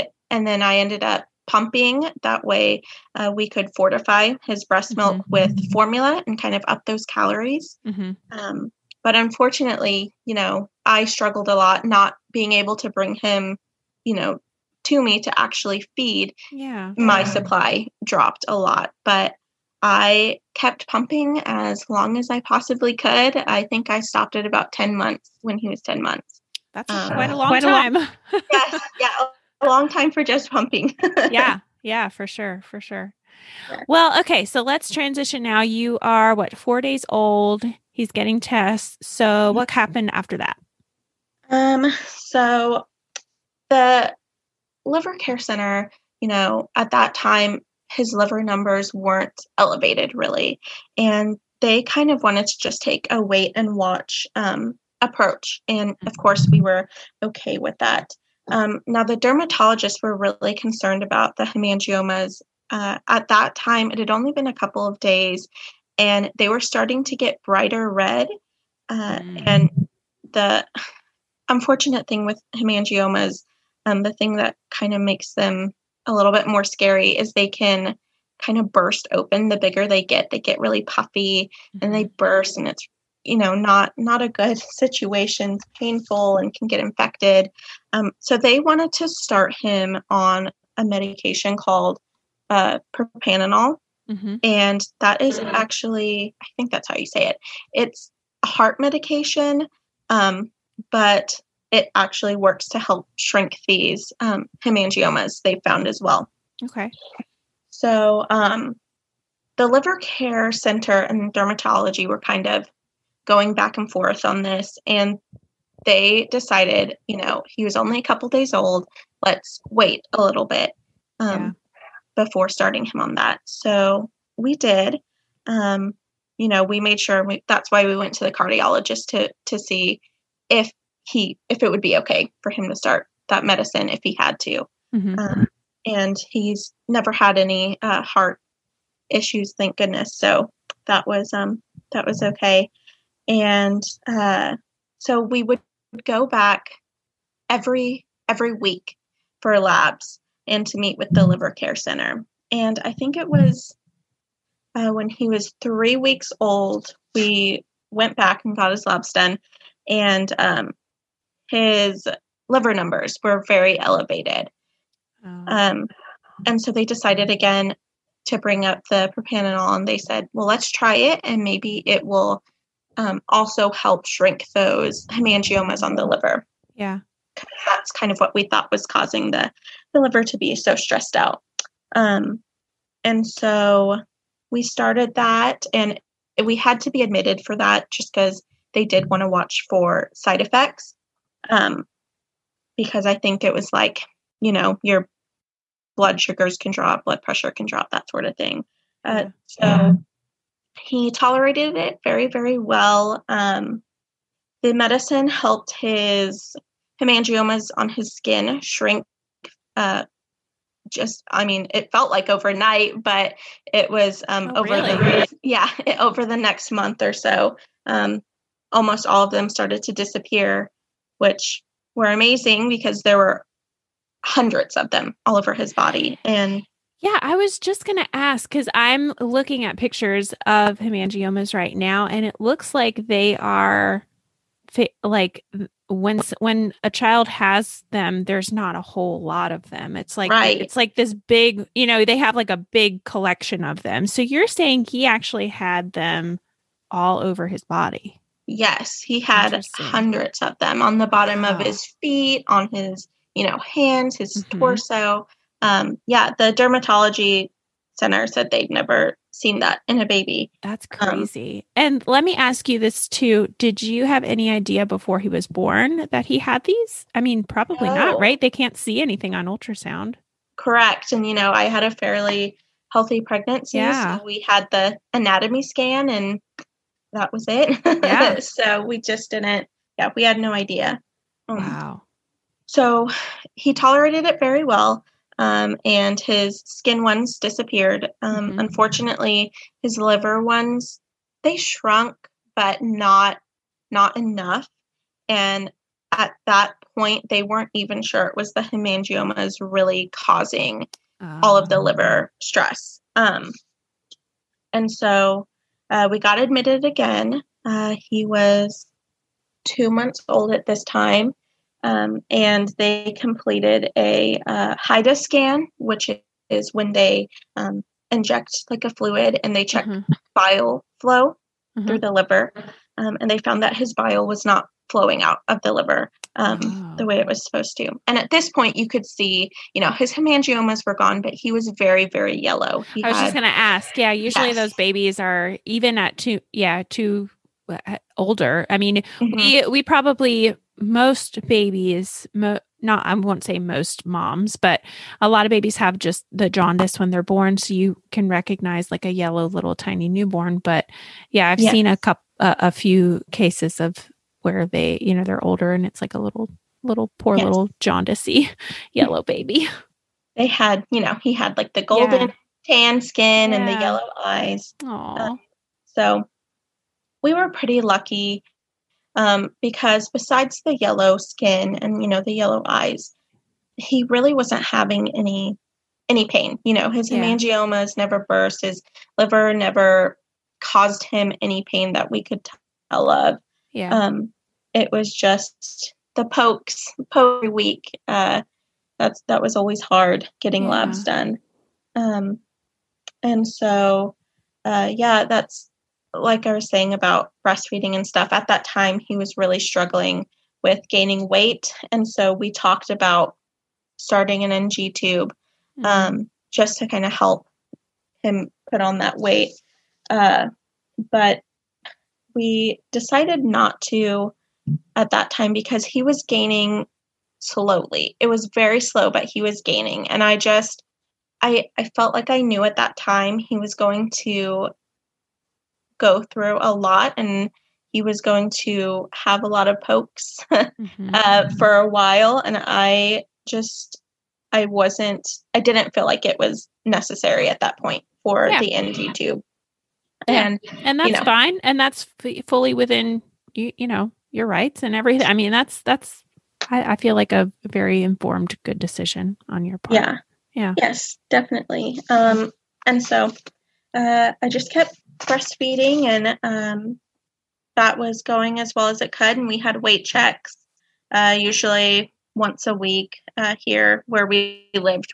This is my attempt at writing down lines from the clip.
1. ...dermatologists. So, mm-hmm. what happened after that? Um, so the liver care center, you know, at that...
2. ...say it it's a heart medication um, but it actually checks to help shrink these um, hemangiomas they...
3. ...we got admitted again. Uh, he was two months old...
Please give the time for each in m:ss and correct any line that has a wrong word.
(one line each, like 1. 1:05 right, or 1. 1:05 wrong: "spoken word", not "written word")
1. 0:38 wrong: "tests", not "dermatologists"
2. 1:37 wrong: "works", not "checks"
3. 5:06 right.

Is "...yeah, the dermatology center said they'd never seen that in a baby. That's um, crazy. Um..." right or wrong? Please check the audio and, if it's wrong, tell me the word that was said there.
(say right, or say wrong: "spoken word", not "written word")
right.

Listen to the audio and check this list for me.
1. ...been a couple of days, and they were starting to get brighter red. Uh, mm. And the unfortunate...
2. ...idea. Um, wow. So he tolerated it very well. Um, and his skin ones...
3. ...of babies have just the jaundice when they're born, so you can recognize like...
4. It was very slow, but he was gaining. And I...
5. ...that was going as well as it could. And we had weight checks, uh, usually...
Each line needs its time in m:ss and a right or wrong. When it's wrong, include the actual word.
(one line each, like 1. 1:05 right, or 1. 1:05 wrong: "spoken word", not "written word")
1. 1:04 right
2. 4:40 right
3. 5:45 right
4. 6:58 right
5. 7:37 right.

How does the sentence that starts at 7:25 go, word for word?
I mean, that's that's I, I feel like a very informed, good decision on your part.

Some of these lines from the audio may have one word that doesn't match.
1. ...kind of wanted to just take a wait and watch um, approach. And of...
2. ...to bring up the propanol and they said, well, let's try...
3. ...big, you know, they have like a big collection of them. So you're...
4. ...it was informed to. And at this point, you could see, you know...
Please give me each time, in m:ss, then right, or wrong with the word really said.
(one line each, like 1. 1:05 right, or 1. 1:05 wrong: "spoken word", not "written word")
1. 0:51 right
2. 2:48 right
3. 4:01 right
4. 5:27 wrong: "supposed", not "informed".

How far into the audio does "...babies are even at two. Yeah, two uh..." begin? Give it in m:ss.
5:34.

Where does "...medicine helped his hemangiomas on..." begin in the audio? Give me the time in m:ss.
3:24.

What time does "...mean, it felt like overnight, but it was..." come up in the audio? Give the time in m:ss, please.
3:31.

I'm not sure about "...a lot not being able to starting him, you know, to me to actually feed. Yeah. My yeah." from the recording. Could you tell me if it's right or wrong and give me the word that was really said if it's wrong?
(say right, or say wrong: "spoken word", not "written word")
wrong: "bring", not "starting".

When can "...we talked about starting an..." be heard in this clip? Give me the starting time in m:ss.
6:42.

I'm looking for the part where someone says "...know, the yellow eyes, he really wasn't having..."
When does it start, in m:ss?
6:12.